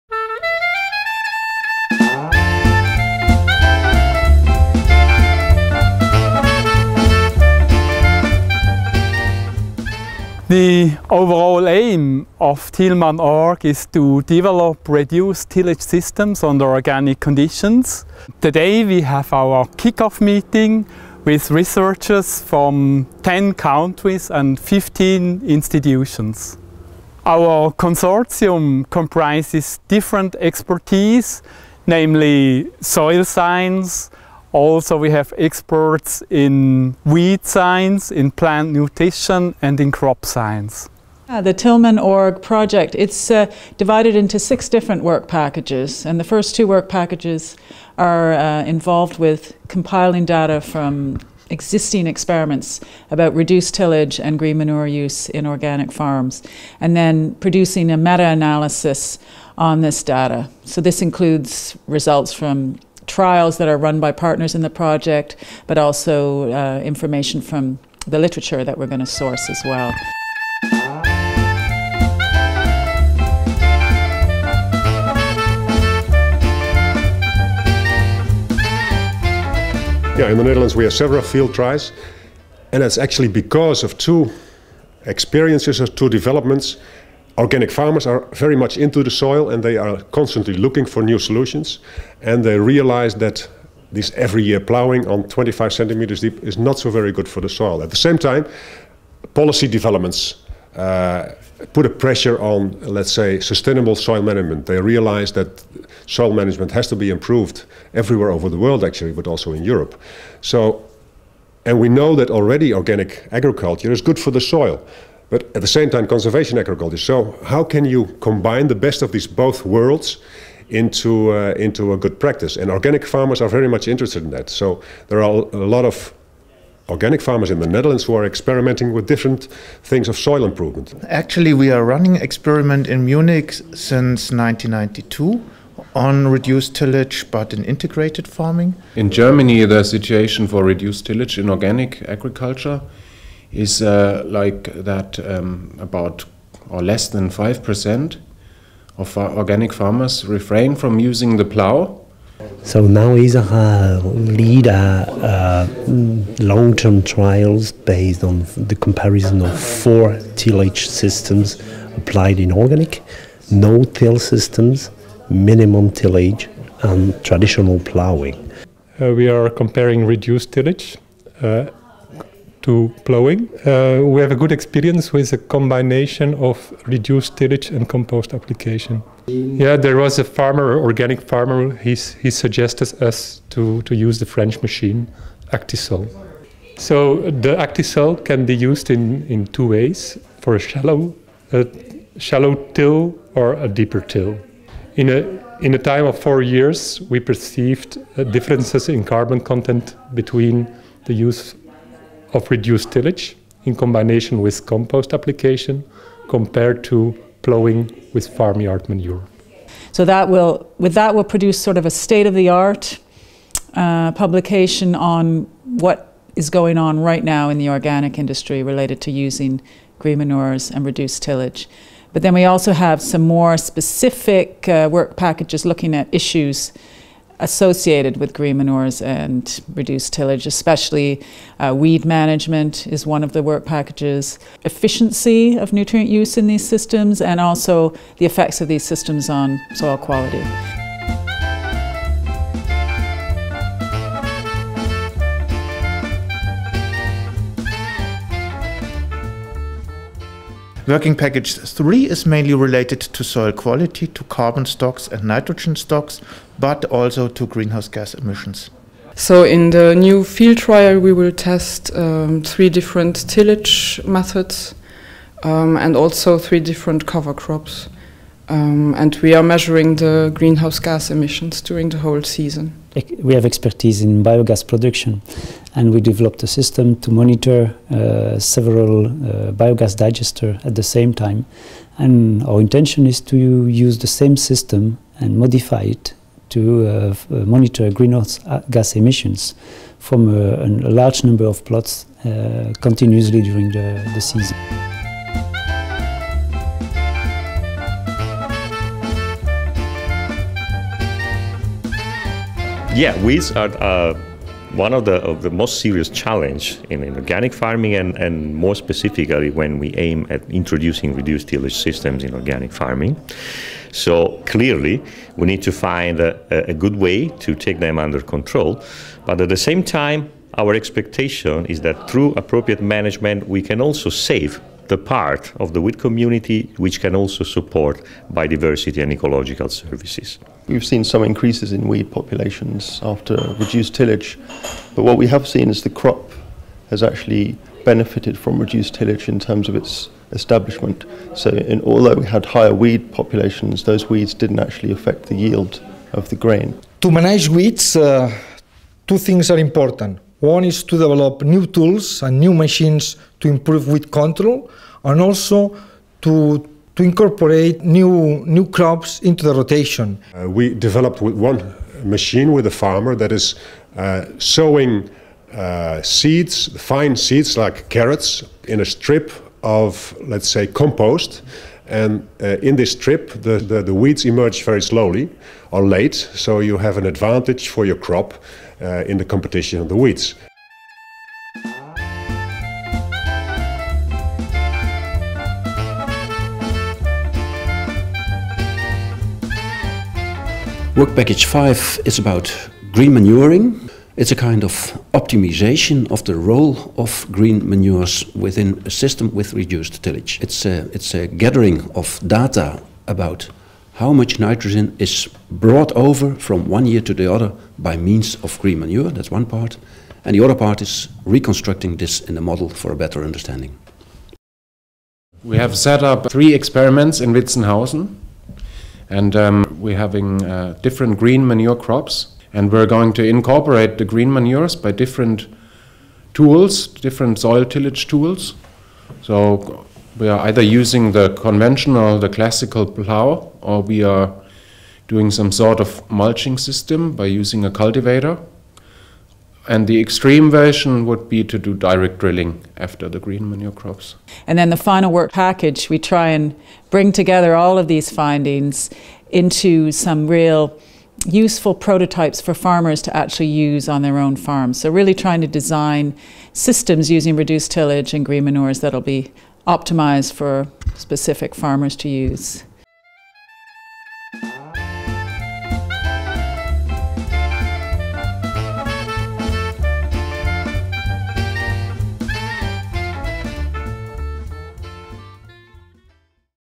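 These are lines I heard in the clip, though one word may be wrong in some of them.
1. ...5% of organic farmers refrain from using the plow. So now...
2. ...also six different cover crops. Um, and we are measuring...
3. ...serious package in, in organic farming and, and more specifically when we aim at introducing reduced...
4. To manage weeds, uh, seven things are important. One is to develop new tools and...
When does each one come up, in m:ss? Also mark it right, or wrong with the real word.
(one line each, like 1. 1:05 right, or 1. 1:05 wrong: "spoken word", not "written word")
1. 2:27 right
2. 4:25 wrong: "three", not "six"
3. 5:05 wrong: "challenge", not "package"
4. 5:46 wrong: "two", not "seven".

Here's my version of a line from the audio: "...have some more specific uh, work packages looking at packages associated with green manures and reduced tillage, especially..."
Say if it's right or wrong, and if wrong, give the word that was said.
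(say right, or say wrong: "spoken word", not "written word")
wrong: "issues", not "packages".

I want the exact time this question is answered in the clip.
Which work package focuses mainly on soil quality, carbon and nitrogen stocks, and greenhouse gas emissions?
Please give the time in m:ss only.
4:10.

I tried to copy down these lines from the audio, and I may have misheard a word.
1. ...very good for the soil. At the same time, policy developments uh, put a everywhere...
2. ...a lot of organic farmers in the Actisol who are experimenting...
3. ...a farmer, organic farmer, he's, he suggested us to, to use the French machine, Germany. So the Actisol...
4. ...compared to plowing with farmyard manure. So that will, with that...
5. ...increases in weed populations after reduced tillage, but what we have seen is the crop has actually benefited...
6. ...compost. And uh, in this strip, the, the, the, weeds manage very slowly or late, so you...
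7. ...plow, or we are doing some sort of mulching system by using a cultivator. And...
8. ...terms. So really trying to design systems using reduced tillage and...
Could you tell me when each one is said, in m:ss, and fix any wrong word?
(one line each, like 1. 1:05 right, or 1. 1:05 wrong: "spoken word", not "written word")
1. 1:36 wrong: "pressure", not "everywhere"
2. 2:05 wrong: "Netherlands", not "Actisol"
3. 3:00 wrong: "Actisol", not "Germany"
4. 3:26 right
5. 5:31 right
6. 6:10 wrong: "emerge", not "manage"
7. 7:12 right
8. 7:34 wrong: "farms", not "terms".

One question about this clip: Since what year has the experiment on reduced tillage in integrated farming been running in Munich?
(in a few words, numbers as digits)
1992.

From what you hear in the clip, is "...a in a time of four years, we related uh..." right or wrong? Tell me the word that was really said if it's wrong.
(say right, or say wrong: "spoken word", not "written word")
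wrong: "perceived", not "related".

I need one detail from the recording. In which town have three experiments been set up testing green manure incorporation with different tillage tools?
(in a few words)
Witzenhausen.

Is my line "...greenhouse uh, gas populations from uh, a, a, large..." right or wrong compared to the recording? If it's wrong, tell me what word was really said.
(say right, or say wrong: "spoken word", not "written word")
wrong: "emissions", not "populations".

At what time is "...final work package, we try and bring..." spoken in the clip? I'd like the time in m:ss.
7:24.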